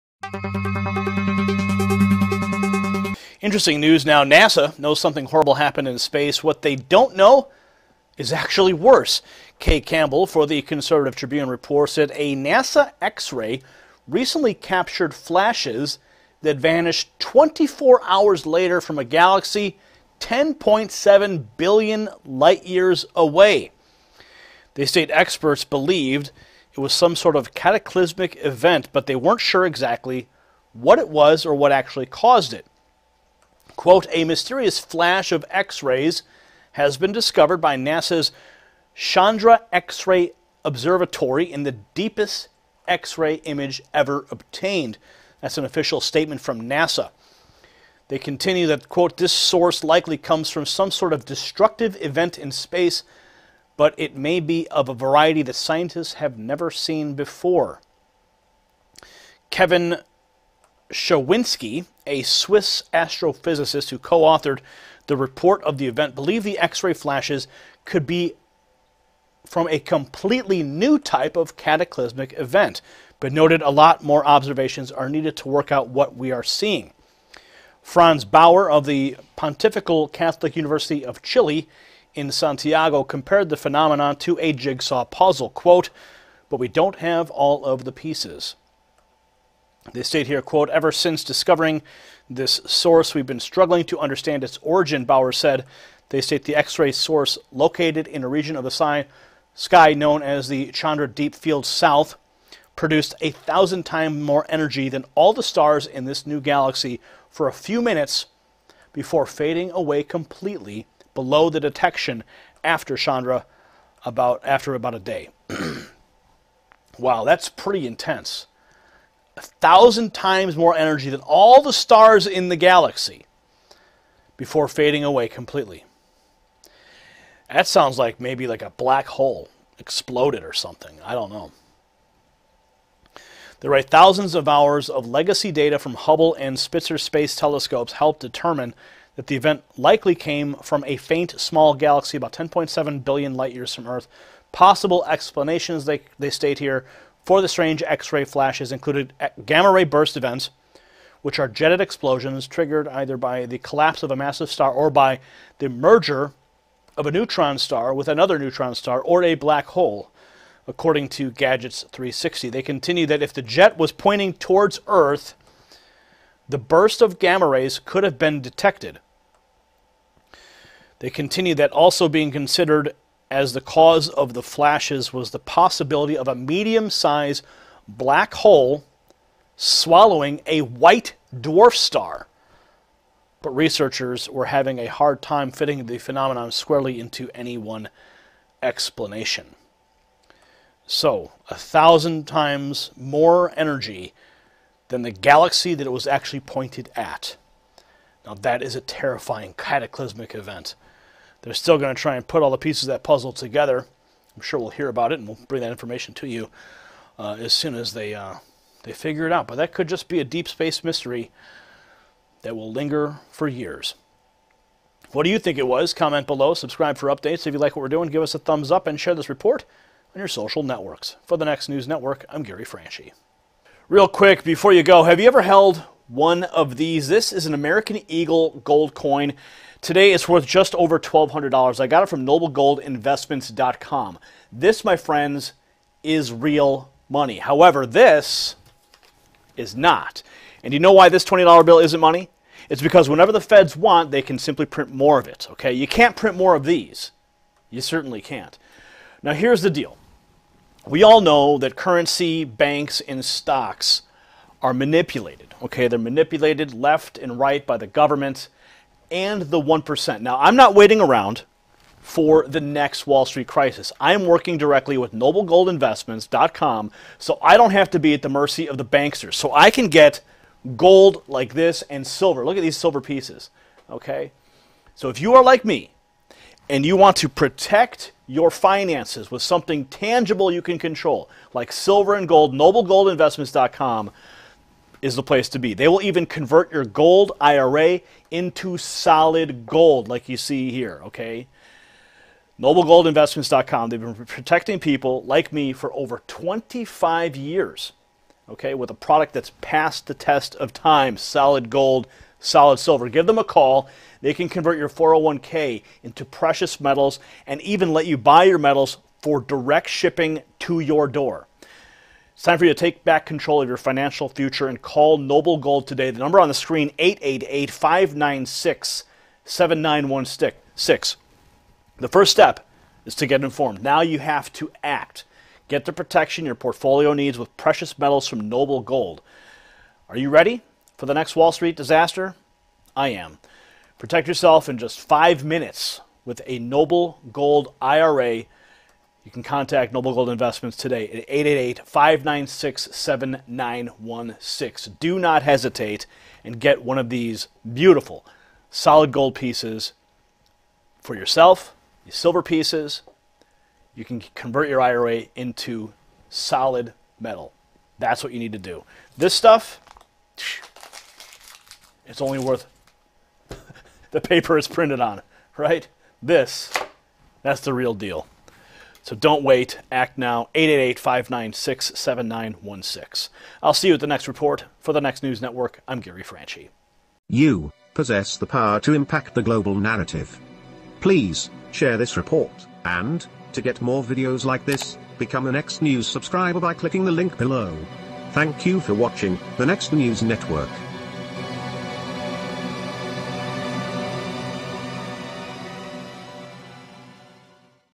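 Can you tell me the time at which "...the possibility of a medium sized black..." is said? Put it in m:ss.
2:55.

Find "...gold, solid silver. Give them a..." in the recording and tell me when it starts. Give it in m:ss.
5:01.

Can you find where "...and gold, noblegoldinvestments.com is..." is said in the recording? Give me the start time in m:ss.
4:42.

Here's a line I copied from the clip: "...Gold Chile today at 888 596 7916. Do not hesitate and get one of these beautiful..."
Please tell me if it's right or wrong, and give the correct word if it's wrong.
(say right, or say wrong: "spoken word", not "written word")
wrong: "Investments", not "Chile".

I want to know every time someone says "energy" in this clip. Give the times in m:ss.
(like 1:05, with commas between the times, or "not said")
1:44, 2:00, 3:13.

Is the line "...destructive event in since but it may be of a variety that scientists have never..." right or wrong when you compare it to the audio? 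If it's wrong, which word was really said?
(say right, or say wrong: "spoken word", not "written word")
wrong: "space", not "since".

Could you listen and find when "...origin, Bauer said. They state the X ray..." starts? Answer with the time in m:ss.
1:34.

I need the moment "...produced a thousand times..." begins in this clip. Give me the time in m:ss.
1:42.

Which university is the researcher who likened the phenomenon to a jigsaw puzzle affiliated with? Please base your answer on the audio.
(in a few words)
Pontifical Catholic University of Chile.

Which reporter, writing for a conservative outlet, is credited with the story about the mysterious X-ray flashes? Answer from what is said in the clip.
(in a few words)
Kay Campbell.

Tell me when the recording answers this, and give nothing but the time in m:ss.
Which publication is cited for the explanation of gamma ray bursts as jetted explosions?
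2:41.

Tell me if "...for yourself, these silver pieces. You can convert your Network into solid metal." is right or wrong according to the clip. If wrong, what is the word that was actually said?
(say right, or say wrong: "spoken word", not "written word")
wrong: "IRA", not "Network".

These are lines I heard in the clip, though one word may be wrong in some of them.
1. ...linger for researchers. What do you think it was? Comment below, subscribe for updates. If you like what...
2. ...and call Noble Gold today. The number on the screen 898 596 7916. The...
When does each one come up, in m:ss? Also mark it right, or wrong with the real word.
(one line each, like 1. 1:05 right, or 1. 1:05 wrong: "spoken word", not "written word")
1. 3:32 wrong: "years", not "researchers"
2. 5:14 wrong: "888", not "898".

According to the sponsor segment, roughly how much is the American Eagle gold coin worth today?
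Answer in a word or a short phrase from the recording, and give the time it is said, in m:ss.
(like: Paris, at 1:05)
just over $1,200, at 3:50.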